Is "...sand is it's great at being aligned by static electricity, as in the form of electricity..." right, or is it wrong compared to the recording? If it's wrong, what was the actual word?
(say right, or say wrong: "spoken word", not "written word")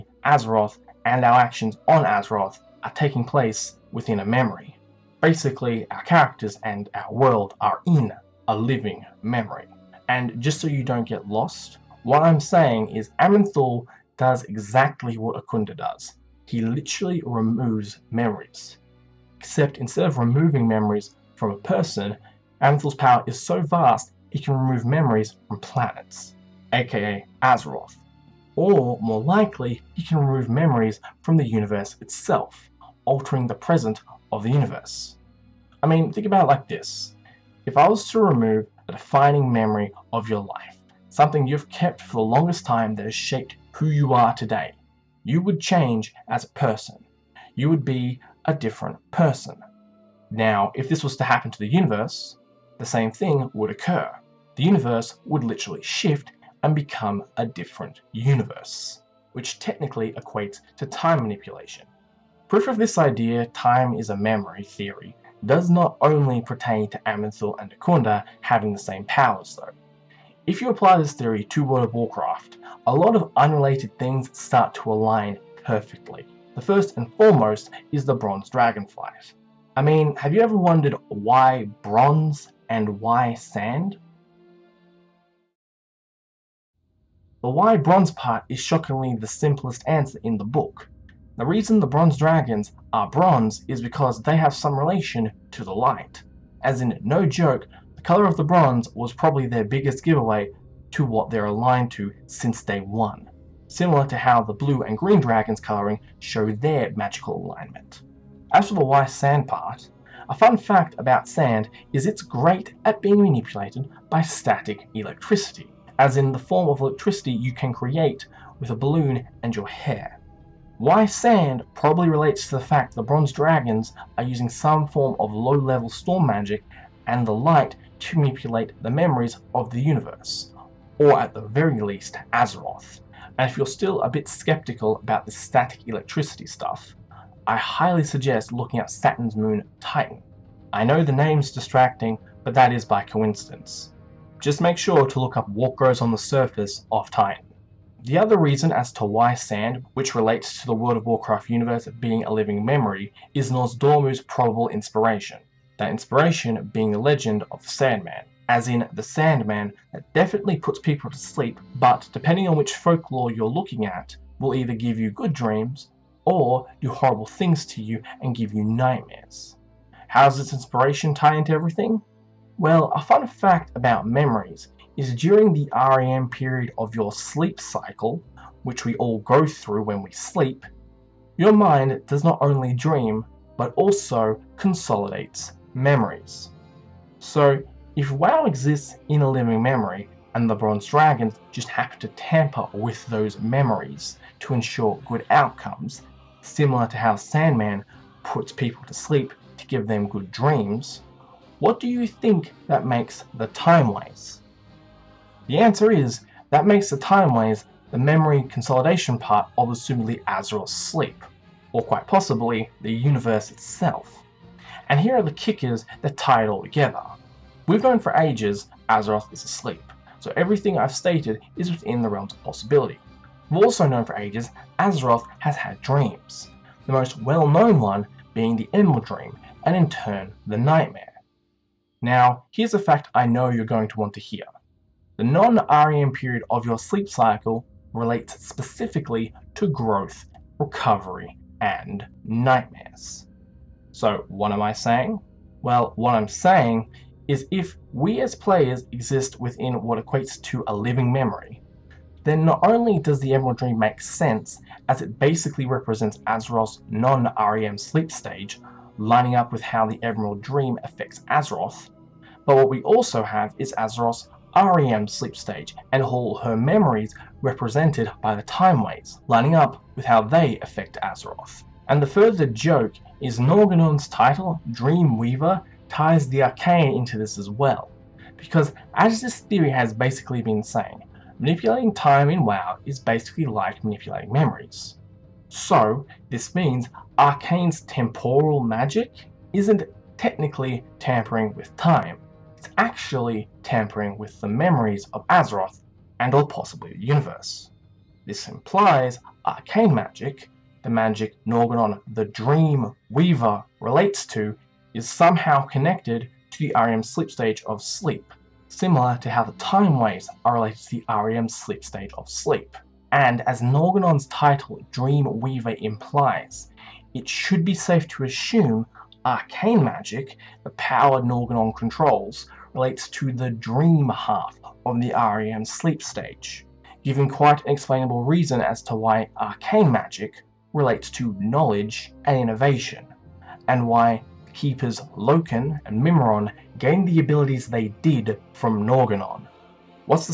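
wrong: "manipulated", not "aligned".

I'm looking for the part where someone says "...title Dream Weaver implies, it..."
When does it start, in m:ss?
5:14.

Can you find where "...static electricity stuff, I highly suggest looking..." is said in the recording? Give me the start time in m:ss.
2:15.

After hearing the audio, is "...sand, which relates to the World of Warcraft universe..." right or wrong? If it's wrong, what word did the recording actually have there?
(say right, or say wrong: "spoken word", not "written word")
right.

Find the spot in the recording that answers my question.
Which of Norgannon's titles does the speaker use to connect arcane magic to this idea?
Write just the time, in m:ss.
4:34.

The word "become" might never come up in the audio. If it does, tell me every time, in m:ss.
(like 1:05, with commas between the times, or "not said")
0:56.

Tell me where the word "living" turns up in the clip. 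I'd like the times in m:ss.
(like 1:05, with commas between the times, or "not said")
0:08, 2:32, 3:09, 4:10.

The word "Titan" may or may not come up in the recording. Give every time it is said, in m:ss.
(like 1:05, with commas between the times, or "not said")
2:19, 2:27.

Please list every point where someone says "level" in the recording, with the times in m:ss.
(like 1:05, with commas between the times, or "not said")
2:05.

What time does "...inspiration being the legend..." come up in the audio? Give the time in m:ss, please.
2:35.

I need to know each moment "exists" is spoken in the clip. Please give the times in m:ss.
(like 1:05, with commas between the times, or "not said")
3:08, 4:08.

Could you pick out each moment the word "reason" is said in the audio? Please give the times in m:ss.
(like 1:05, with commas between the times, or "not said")
1:31, 2:28, 5:28.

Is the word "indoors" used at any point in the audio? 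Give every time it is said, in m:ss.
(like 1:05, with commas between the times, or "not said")
not said.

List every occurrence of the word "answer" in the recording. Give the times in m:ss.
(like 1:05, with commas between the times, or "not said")
1:29, 3:25.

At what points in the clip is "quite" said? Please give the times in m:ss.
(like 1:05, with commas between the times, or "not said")
3:31, 5:27.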